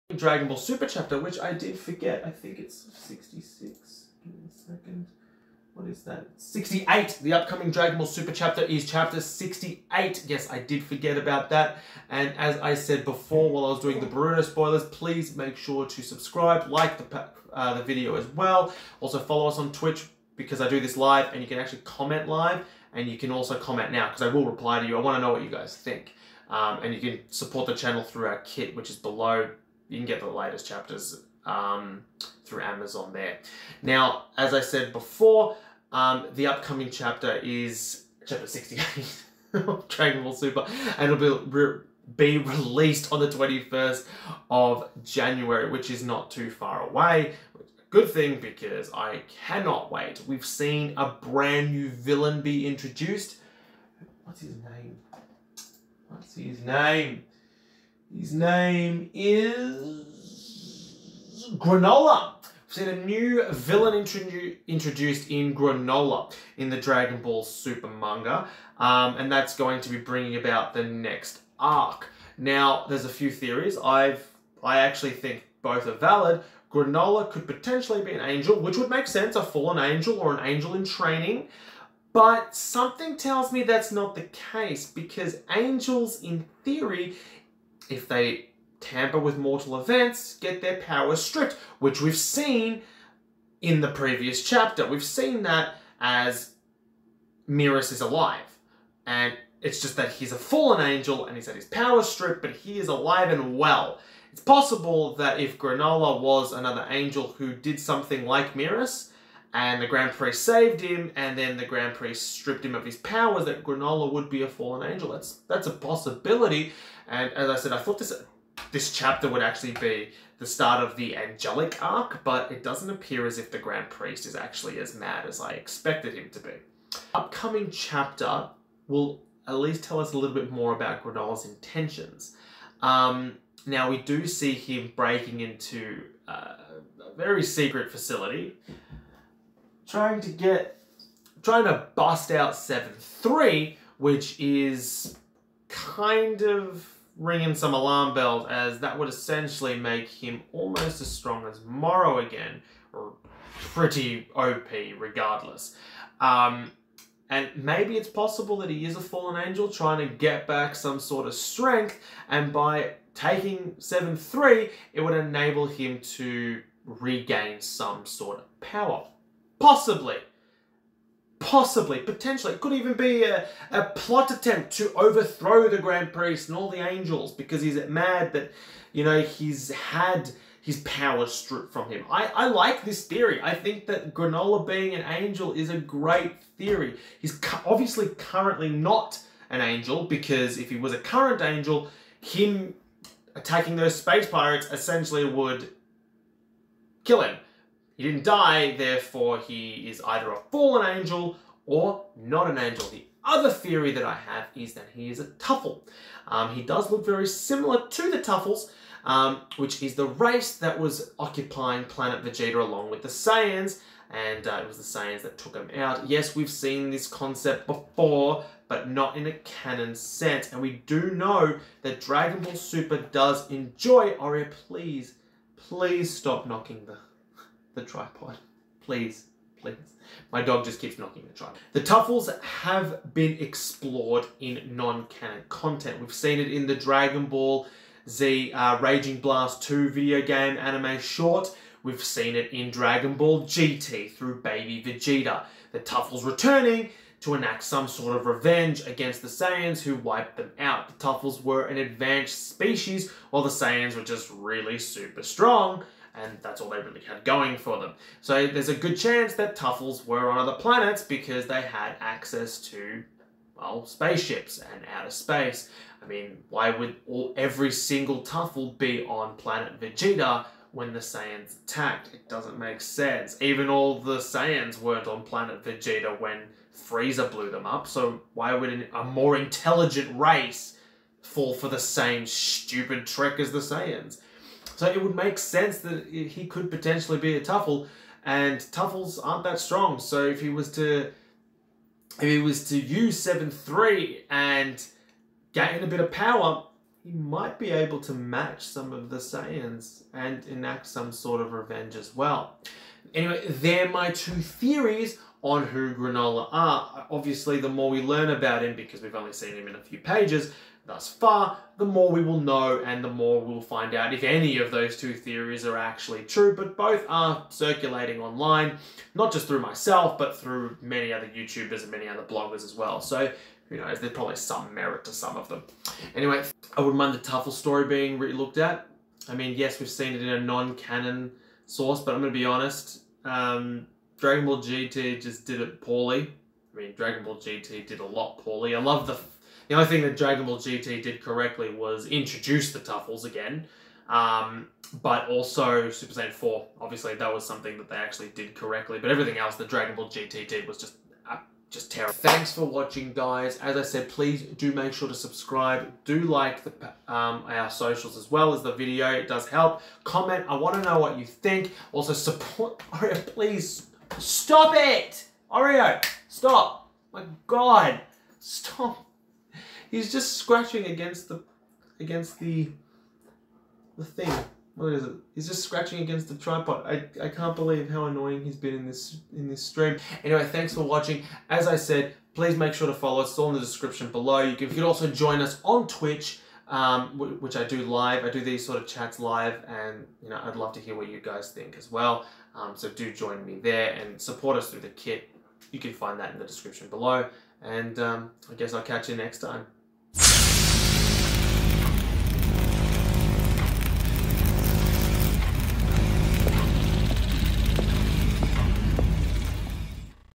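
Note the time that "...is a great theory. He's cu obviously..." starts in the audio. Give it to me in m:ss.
3:05.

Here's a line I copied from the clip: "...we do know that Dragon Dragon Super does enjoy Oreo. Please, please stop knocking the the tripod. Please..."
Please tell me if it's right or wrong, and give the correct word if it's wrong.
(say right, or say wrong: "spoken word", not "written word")
wrong: "Ball", not "Dragon".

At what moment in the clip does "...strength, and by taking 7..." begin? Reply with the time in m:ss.
2:41.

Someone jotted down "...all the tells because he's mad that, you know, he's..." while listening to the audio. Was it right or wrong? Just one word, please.
wrong.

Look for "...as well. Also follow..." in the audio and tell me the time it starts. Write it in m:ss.
0:18.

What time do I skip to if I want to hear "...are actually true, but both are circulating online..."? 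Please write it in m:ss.
5:15.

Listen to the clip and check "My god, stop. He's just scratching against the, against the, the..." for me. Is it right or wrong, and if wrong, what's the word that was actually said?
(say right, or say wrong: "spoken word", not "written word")
right.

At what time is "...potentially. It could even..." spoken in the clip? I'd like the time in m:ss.
2:51.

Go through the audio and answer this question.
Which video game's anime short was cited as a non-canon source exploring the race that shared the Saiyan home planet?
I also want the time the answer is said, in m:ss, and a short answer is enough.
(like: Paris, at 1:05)
Raging Blast 2, at 3:58.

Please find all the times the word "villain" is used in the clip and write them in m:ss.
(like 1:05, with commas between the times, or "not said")
0:51, 1:03.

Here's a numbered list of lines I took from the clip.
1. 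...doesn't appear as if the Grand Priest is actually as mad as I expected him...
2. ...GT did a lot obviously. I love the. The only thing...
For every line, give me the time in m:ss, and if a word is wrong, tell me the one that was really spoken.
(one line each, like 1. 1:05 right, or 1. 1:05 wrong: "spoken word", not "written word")
1. 2:02 right
2. 5:37 wrong: "poorly", not "obviously".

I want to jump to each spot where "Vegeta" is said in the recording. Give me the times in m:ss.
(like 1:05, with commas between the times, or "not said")
3:32, 4:04, 4:29, 4:35.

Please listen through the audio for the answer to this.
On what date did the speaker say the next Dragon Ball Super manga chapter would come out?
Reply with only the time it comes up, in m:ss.
0:43.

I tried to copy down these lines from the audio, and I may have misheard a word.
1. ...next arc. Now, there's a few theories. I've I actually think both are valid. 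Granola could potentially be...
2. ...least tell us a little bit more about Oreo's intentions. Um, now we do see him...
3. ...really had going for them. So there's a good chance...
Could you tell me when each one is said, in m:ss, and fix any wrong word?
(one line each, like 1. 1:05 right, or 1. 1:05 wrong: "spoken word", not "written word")
1. 1:10 right
2. 2:09 wrong: "Granola", not "Oreo"
3. 4:16 right.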